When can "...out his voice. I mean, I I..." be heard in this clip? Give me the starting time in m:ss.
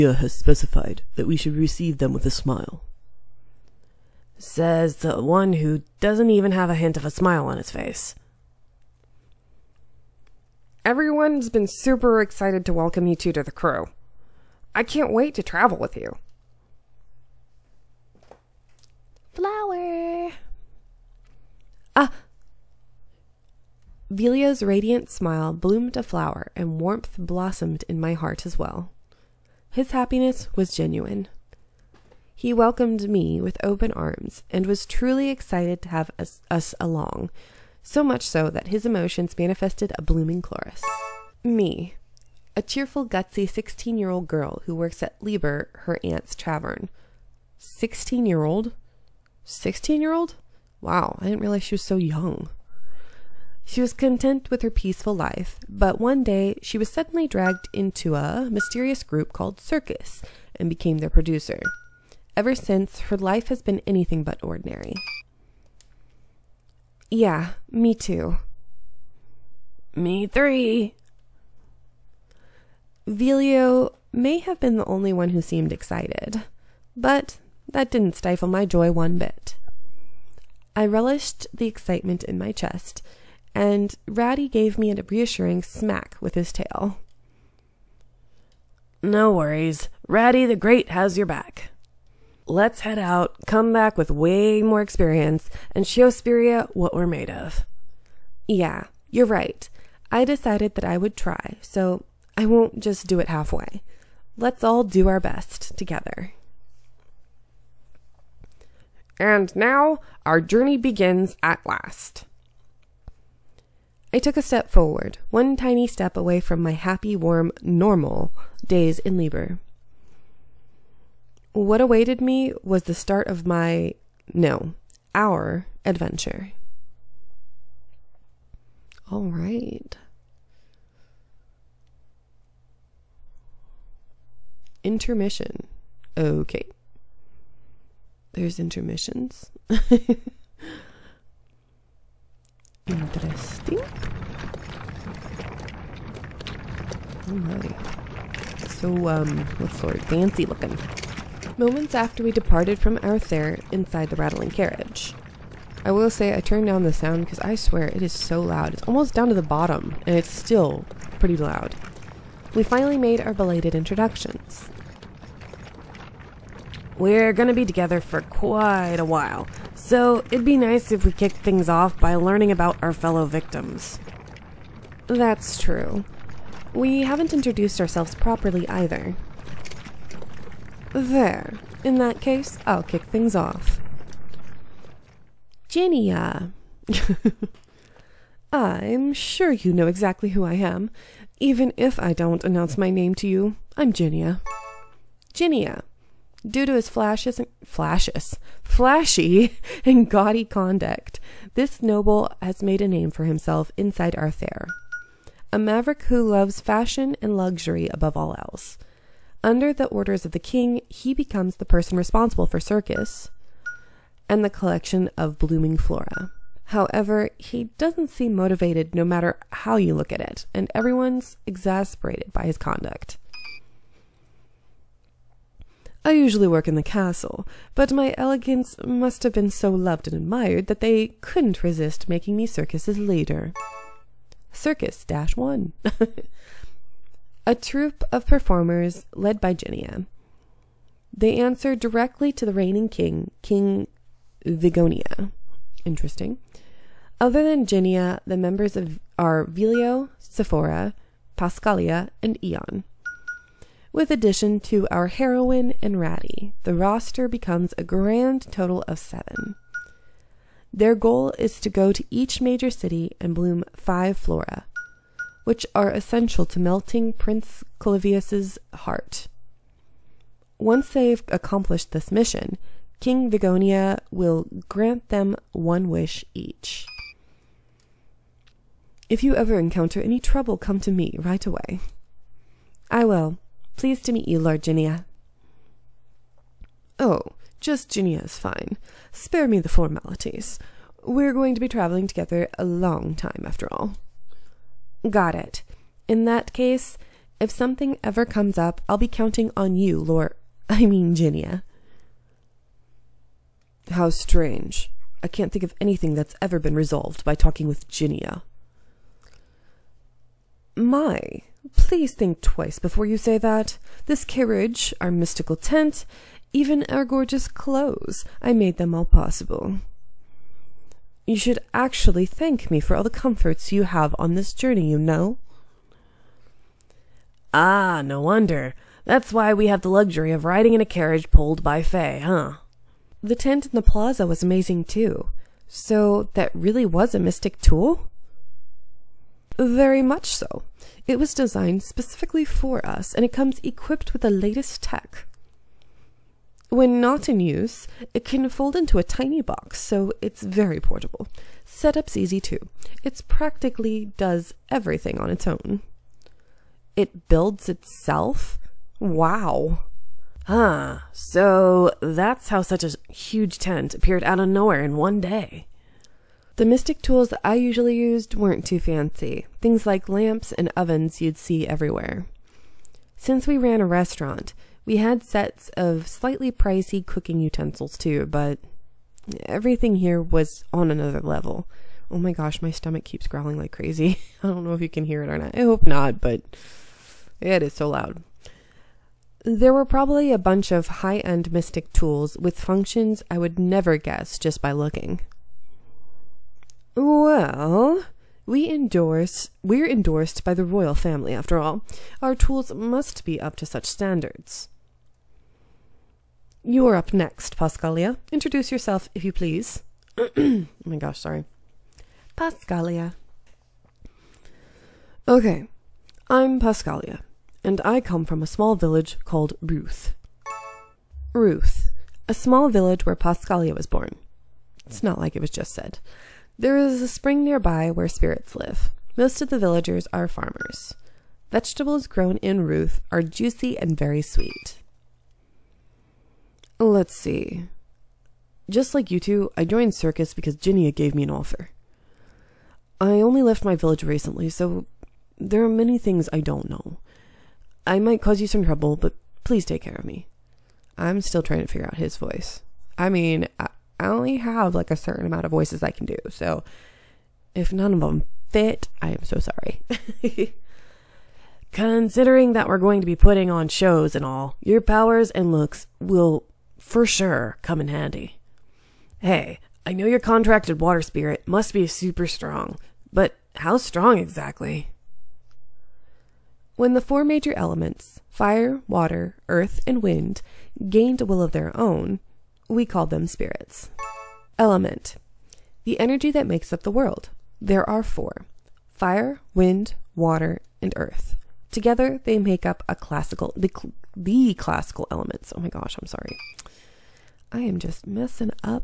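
7:31.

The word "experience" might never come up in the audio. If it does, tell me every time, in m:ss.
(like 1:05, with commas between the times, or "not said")
1:34.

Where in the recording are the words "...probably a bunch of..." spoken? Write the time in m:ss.
6:29.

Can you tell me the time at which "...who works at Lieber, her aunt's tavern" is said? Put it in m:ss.
0:44.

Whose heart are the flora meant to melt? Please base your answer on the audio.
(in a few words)
Prince Clavius.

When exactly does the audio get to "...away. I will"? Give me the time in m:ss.
4:41.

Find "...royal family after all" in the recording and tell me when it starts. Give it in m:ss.
6:40.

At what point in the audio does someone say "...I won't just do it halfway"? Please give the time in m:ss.
1:42.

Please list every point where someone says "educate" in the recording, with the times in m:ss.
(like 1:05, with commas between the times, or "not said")
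not said.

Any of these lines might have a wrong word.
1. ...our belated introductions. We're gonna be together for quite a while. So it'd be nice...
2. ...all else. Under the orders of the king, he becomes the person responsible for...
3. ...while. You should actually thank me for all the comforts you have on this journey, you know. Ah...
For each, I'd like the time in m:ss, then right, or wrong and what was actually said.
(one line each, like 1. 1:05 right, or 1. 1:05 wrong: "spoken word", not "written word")
1. 2:43 right
2. 3:28 right
3. 5:19 wrong: "possible", not "while".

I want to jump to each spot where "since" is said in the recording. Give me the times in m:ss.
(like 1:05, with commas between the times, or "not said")
1:02, 6:13.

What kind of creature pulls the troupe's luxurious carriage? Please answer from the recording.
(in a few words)
Fay.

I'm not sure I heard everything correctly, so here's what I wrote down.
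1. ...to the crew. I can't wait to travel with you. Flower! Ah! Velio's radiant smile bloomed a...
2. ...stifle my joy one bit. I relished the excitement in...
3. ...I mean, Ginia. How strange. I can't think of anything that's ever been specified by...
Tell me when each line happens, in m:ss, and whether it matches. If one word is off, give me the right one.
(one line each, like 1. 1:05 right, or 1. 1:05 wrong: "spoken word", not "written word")
1. 0:13 right
2. 1:18 right
3. 5:00 wrong: "resolved", not "specified".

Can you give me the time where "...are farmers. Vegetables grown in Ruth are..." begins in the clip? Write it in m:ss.
7:10.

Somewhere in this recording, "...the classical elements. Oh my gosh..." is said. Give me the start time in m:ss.
8:14.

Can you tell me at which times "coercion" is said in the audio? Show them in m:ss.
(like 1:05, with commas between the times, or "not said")
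not said.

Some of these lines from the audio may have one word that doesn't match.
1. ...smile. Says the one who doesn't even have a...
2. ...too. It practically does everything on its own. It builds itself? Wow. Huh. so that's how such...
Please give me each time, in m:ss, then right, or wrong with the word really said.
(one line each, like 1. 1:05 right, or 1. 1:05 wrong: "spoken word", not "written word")
1. 0:02 right
2. 5:52 right.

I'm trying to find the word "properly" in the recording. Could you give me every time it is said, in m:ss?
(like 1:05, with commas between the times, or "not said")
2:58.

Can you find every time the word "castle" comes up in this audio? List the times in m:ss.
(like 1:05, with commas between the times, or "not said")
3:46.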